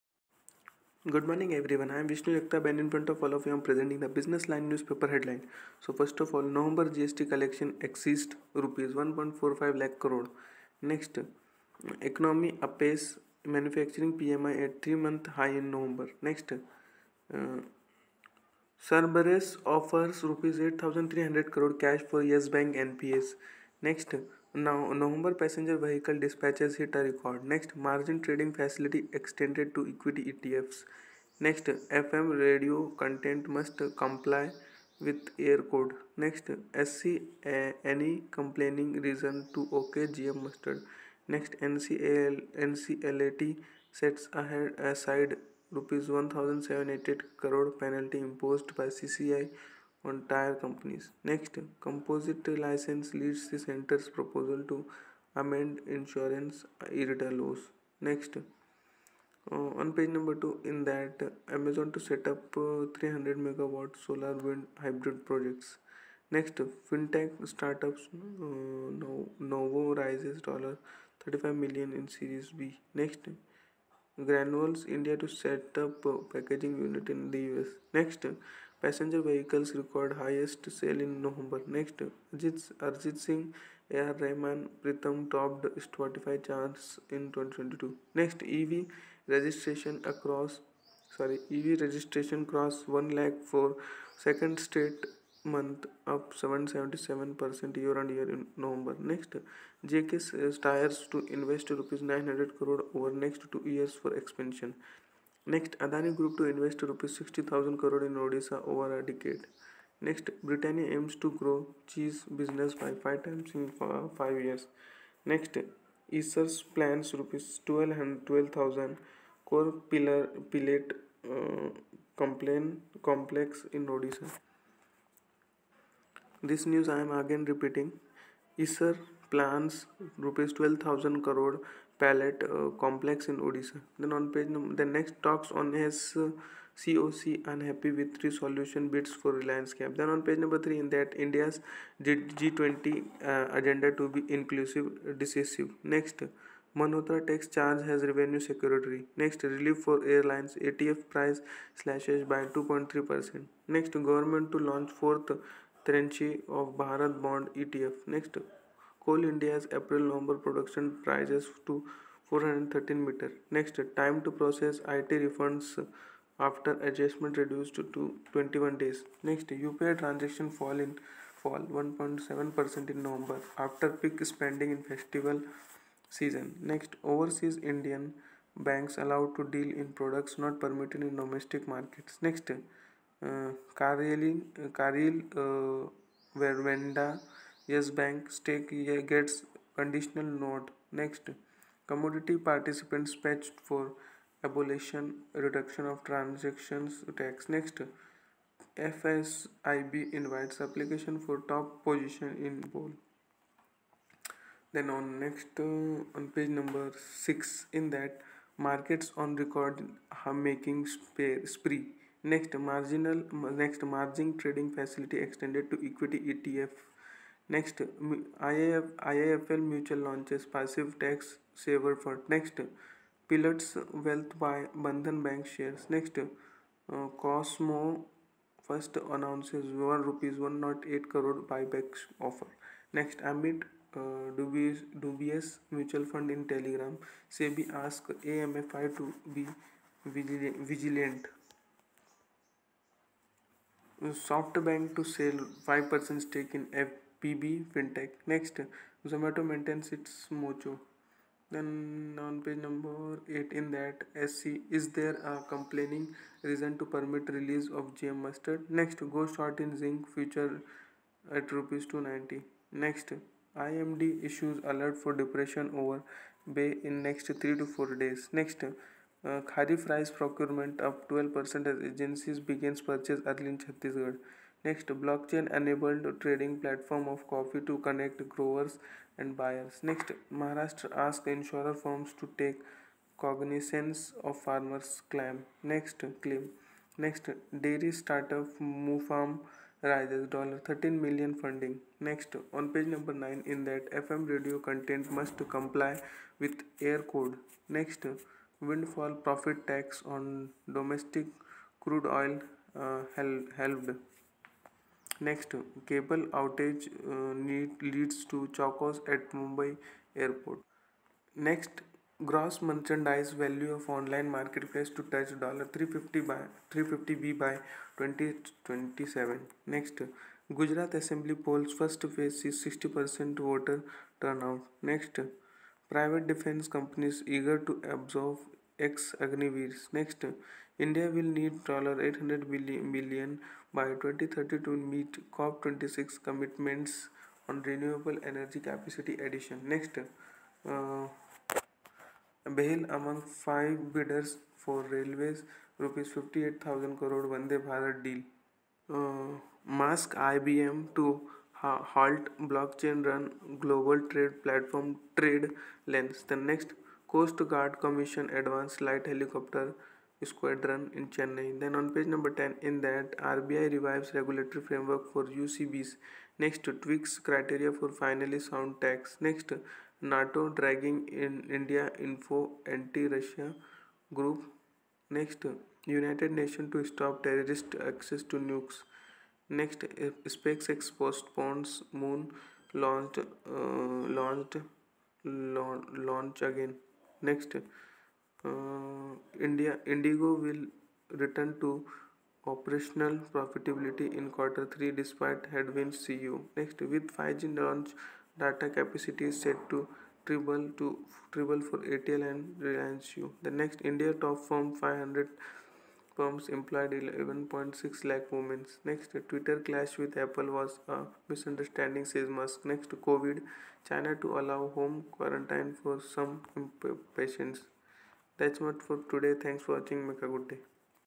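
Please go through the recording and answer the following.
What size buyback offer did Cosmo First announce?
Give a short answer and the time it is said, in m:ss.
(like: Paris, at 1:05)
Rs 108 crore, at 3:50.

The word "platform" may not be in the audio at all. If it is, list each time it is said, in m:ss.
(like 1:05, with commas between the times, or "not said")
4:36, 5:54.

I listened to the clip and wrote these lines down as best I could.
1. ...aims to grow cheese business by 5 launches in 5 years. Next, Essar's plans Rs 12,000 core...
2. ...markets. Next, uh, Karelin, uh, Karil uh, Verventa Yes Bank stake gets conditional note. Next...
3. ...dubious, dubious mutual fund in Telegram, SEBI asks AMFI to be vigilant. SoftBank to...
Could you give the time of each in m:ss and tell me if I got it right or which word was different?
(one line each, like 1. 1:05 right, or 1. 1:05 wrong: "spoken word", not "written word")
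1. 1:50 wrong: "times", not "launches"
2. 3:01 right
3. 3:54 right.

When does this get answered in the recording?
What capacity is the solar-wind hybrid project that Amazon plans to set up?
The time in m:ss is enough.
1:02.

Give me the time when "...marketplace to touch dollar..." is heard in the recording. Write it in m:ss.
5:14.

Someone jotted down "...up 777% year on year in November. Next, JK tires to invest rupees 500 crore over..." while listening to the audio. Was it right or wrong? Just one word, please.
wrong.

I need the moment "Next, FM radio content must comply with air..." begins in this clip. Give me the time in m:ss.
0:31.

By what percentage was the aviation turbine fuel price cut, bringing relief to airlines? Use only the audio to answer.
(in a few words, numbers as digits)
2.3 percent.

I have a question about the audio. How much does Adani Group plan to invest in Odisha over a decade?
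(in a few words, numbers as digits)
Rs 60,000 crore.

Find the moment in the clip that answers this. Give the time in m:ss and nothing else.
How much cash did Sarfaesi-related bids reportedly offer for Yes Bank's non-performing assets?
0:20.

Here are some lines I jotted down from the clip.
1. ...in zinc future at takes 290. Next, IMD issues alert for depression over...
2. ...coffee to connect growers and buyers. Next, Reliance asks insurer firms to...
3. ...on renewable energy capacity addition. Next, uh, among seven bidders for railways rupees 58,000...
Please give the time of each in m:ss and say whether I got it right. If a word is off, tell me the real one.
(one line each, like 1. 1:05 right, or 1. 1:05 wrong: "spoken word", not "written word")
1. 4:19 wrong: "rupees", not "takes"
2. 4:37 wrong: "Maharashtra", not "Reliance"
3. 5:37 wrong: "five", not "seven".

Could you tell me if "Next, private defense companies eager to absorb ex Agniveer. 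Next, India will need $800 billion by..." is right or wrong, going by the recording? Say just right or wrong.
right.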